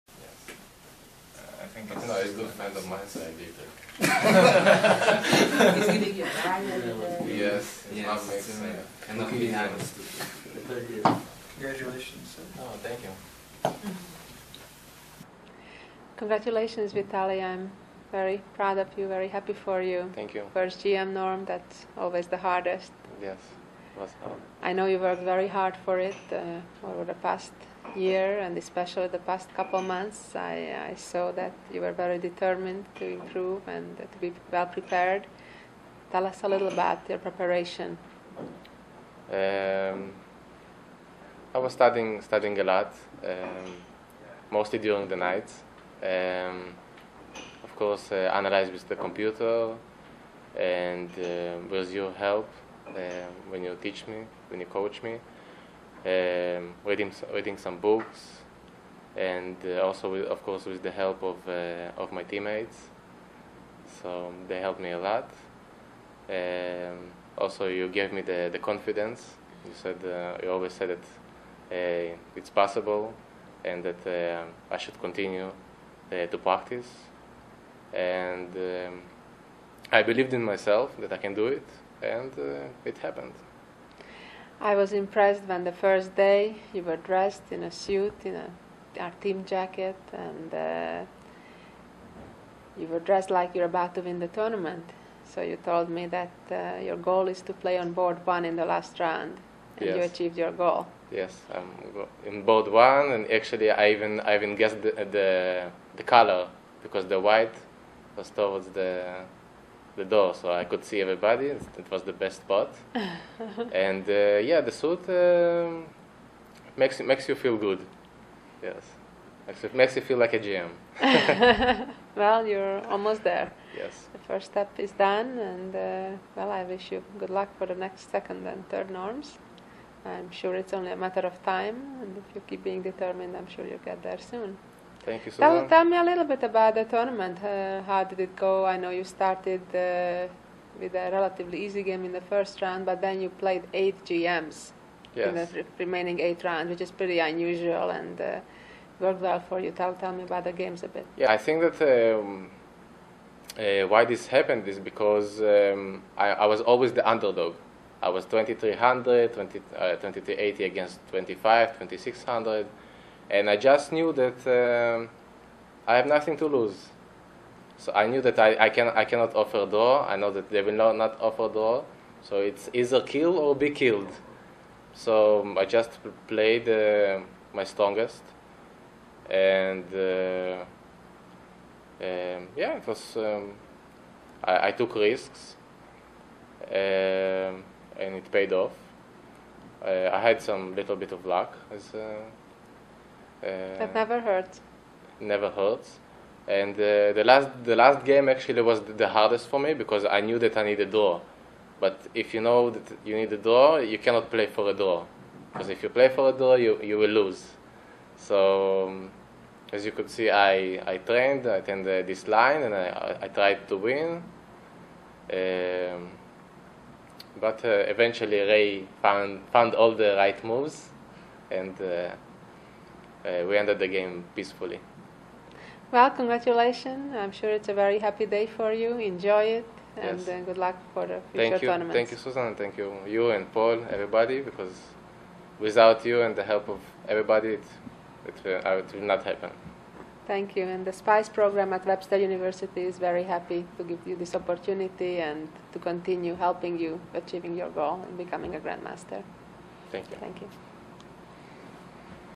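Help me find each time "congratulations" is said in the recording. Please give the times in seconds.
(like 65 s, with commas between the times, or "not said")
11 s, 16 s, 226 s.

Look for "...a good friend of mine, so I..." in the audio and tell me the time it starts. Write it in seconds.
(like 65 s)
2 s.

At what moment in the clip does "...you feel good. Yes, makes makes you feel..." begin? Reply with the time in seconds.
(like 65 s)
117 s.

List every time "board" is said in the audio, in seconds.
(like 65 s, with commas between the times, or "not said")
97 s, 102 s.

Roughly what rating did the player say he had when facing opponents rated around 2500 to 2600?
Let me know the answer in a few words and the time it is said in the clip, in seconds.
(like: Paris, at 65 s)
2380, at 159 s.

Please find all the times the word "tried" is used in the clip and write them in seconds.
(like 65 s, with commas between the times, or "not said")
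213 s.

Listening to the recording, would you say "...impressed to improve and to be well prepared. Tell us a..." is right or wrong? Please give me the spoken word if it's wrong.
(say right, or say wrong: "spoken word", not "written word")
wrong: "determined", not "impressed".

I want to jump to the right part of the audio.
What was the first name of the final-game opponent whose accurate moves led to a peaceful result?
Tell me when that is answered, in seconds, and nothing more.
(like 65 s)
218 s.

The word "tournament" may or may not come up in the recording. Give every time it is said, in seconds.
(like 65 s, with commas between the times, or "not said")
94 s, 136 s, 231 s.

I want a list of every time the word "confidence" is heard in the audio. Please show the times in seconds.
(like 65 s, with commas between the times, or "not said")
68 s.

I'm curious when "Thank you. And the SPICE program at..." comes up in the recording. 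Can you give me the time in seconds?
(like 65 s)
240 s.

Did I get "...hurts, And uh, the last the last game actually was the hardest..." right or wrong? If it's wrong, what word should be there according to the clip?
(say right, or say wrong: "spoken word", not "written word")
right.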